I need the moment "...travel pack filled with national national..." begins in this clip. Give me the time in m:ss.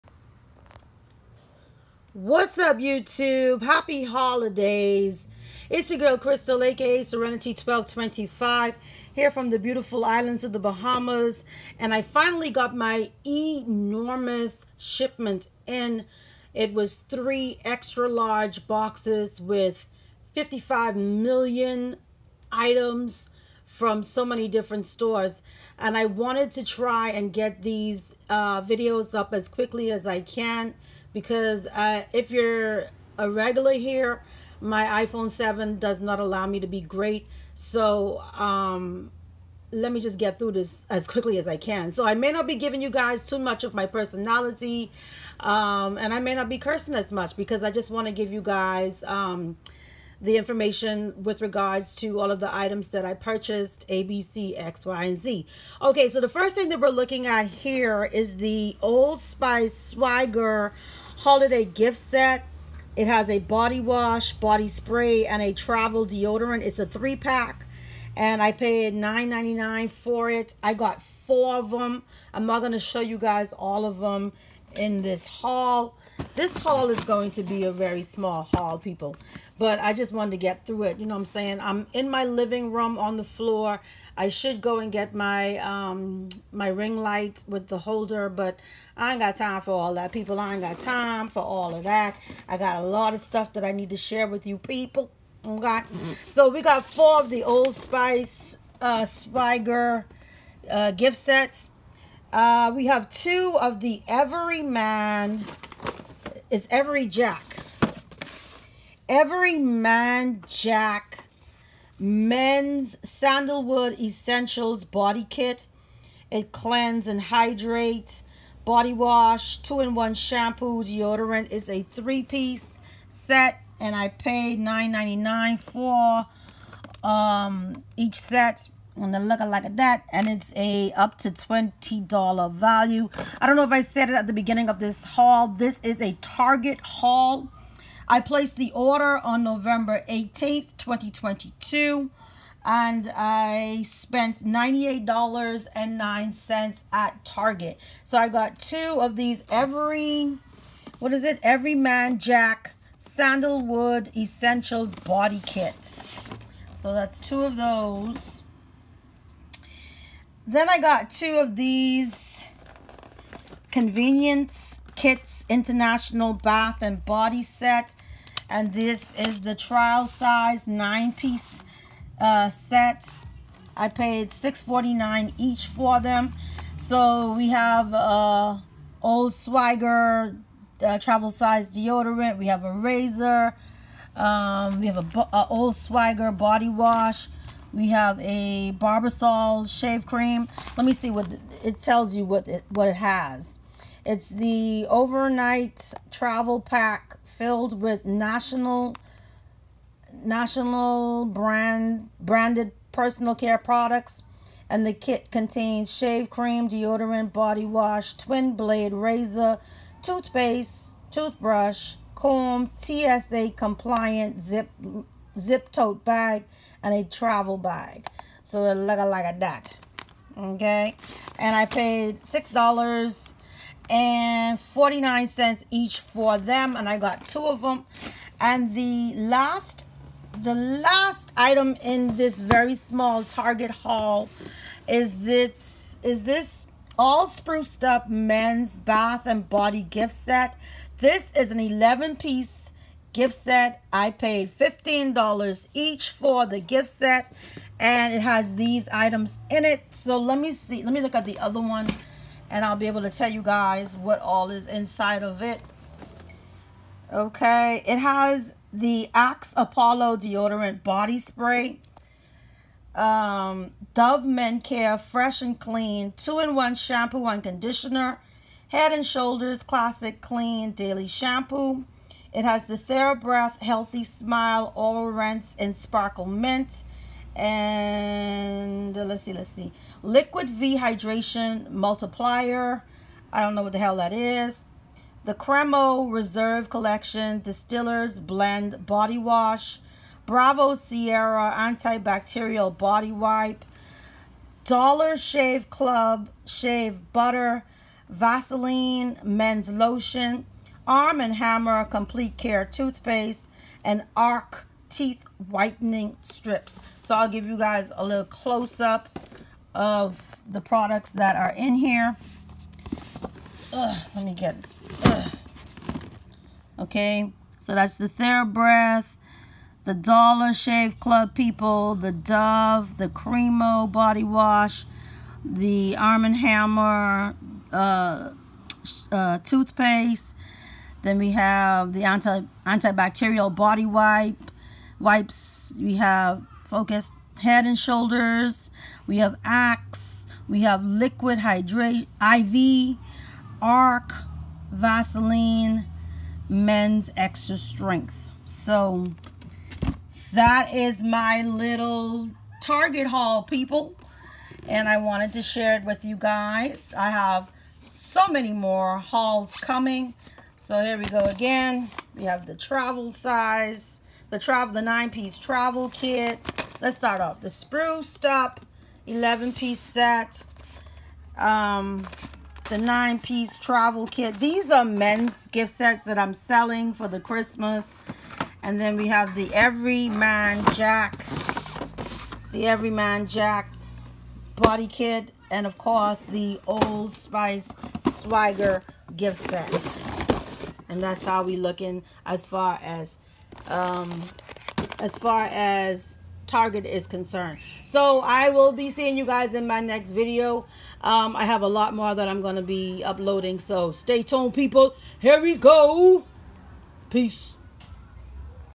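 3:16.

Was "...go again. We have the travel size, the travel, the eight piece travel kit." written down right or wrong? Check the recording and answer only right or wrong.
wrong.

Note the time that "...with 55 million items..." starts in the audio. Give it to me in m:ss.
0:19.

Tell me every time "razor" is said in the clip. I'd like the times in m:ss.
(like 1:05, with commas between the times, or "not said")
3:02, 3:28.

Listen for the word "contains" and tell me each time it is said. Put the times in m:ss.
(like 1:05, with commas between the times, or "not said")
3:25.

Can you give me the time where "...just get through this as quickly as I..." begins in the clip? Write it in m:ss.
0:40.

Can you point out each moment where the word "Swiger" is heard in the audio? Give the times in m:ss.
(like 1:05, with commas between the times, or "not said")
2:59, 3:05.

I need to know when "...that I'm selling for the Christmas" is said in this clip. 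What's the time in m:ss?
6:16.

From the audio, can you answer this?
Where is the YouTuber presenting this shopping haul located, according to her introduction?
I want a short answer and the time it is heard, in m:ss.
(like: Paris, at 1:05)
the Bahamas, at 0:10.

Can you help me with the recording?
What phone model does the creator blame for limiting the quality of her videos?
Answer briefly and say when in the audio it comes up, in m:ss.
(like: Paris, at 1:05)
iPhone 7, at 0:35.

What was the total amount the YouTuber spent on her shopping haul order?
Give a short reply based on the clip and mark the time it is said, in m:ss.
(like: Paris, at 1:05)
$98.09, at 2:24.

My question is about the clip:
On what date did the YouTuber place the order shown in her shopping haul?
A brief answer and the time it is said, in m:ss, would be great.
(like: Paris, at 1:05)
November 18th 2022, at 2:19.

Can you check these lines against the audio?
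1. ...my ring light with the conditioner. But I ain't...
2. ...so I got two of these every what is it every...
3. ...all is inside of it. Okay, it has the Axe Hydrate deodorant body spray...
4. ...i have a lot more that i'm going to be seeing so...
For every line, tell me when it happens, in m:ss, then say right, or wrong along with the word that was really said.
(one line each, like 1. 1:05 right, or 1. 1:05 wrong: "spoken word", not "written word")
1. 1:26 wrong: "holder", not "conditioner"
2. 2:28 right
3. 4:14 wrong: "Apollo", not "Hydrate"
4. 6:41 wrong: "uploading", not "seeing".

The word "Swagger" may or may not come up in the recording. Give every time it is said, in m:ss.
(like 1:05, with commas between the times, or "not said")
0:59, 6:28.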